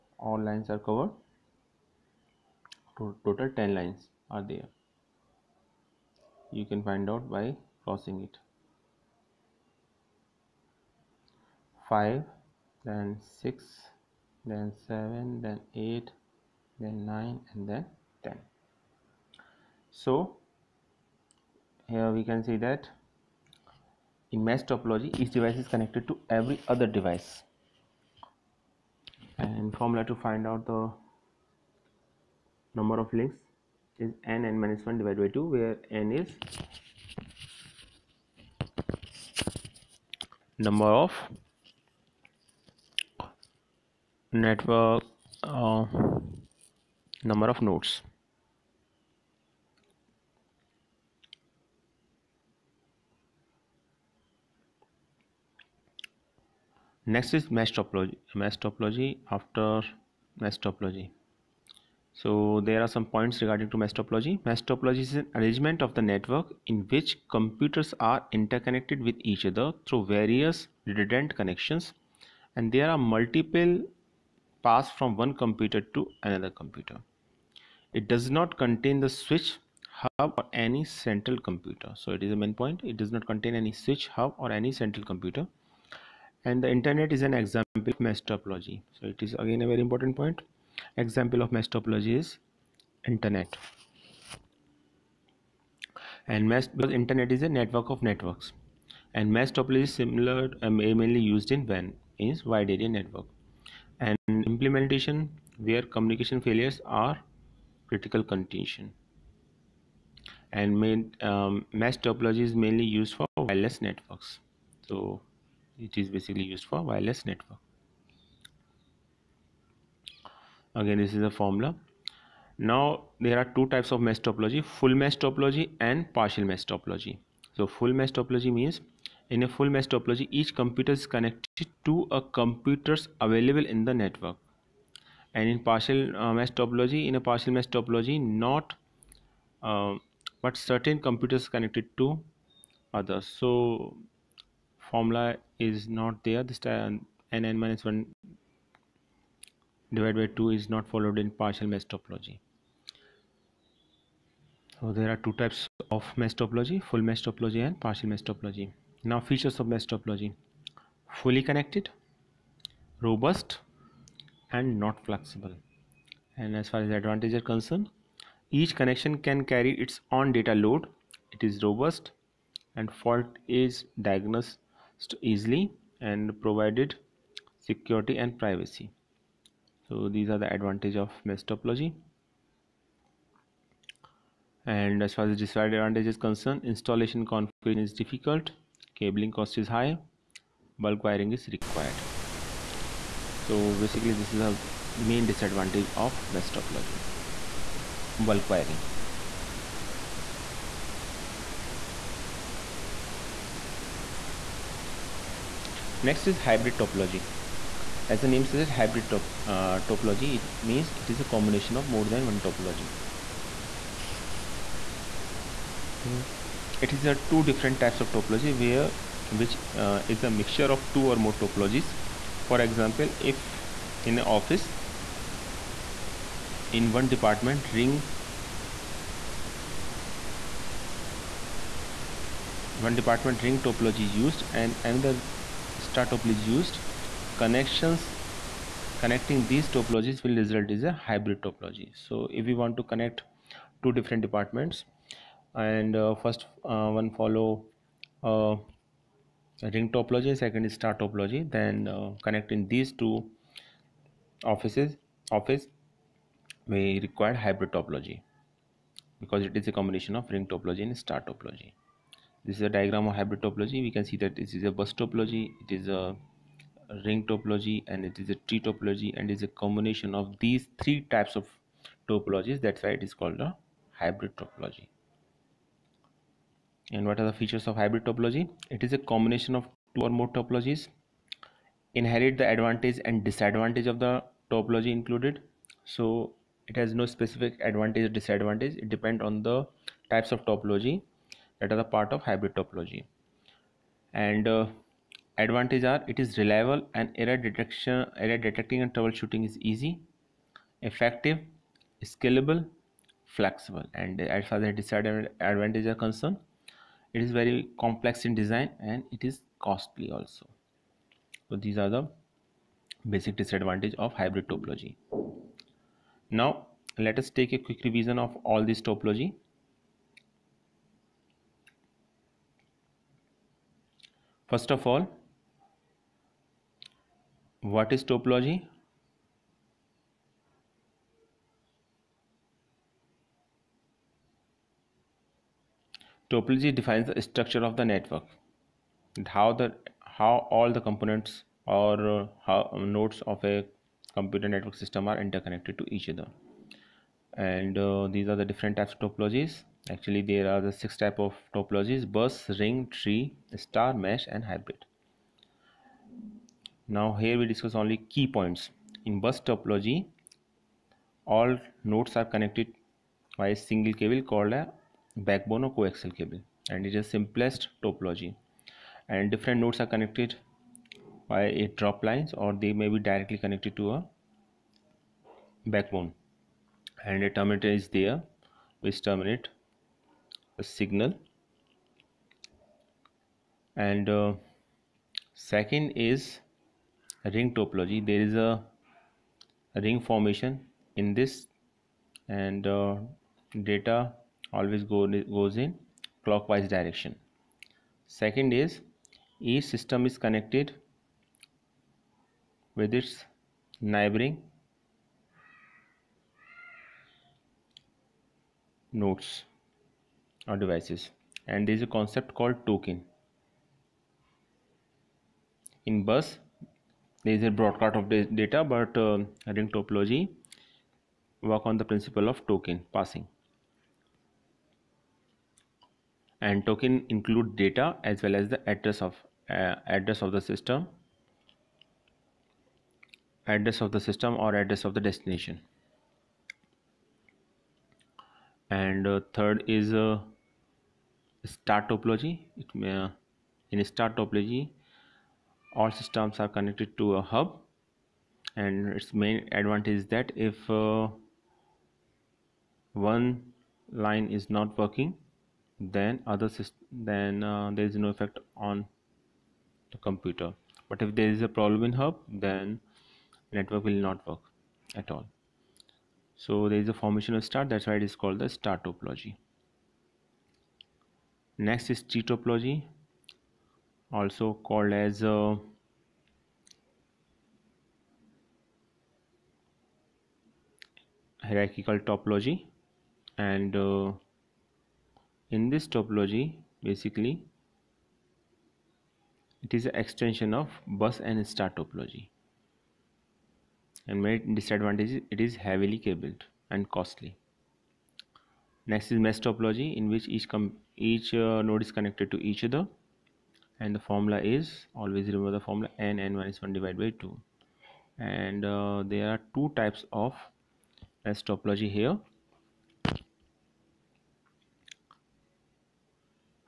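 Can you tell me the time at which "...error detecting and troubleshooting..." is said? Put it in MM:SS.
04:58.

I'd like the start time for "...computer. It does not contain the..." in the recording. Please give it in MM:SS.
01:16.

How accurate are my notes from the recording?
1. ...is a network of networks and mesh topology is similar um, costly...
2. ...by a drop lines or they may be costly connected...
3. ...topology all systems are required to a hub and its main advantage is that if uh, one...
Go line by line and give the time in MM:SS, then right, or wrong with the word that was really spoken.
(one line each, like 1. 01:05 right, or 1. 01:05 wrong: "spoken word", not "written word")
1. 01:37 wrong: "mainly", not "costly"
2. 06:11 wrong: "directly", not "costly"
3. 07:24 wrong: "connected", not "required".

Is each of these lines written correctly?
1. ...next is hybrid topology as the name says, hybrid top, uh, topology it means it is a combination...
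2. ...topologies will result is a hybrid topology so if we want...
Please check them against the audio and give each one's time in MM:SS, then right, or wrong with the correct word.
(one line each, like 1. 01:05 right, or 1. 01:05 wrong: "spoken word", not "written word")
1. 03:26 right
2. 03:59 right.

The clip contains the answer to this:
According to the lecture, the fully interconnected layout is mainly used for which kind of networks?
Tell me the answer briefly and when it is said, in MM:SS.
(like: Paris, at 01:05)
Wireless networks, at 01:53.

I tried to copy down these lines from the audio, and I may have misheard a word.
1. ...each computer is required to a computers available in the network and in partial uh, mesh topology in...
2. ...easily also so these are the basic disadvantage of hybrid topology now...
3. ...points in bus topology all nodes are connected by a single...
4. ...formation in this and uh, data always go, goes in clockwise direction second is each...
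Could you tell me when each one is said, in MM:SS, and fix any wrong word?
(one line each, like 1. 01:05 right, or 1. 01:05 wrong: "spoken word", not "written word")
1. 02:10 wrong: "connected", not "required"
2. 05:09 wrong: "costly", not "easily"
3. 05:58 right
4. 06:29 right.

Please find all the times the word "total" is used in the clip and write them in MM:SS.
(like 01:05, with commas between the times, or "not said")
00:02.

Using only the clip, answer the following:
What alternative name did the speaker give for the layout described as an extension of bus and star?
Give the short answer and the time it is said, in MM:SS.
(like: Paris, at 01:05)
Hierarchical topology, at 08:01.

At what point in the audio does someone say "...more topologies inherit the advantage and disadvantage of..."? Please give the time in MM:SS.
04:40.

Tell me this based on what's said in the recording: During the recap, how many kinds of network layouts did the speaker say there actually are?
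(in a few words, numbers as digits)
6.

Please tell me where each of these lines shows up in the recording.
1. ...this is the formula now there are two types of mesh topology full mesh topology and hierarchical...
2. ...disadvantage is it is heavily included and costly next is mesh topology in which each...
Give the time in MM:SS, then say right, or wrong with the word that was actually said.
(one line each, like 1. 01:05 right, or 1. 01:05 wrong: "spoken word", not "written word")
1. 02:00 wrong: "partial", not "hierarchical"
2. 08:14 wrong: "cabled", not "included".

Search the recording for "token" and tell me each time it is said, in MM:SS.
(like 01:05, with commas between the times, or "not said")
06:52, 07:02, 07:06.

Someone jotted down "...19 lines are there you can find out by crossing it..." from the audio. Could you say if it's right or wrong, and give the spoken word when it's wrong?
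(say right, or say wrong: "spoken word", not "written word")
wrong: "10", not "19".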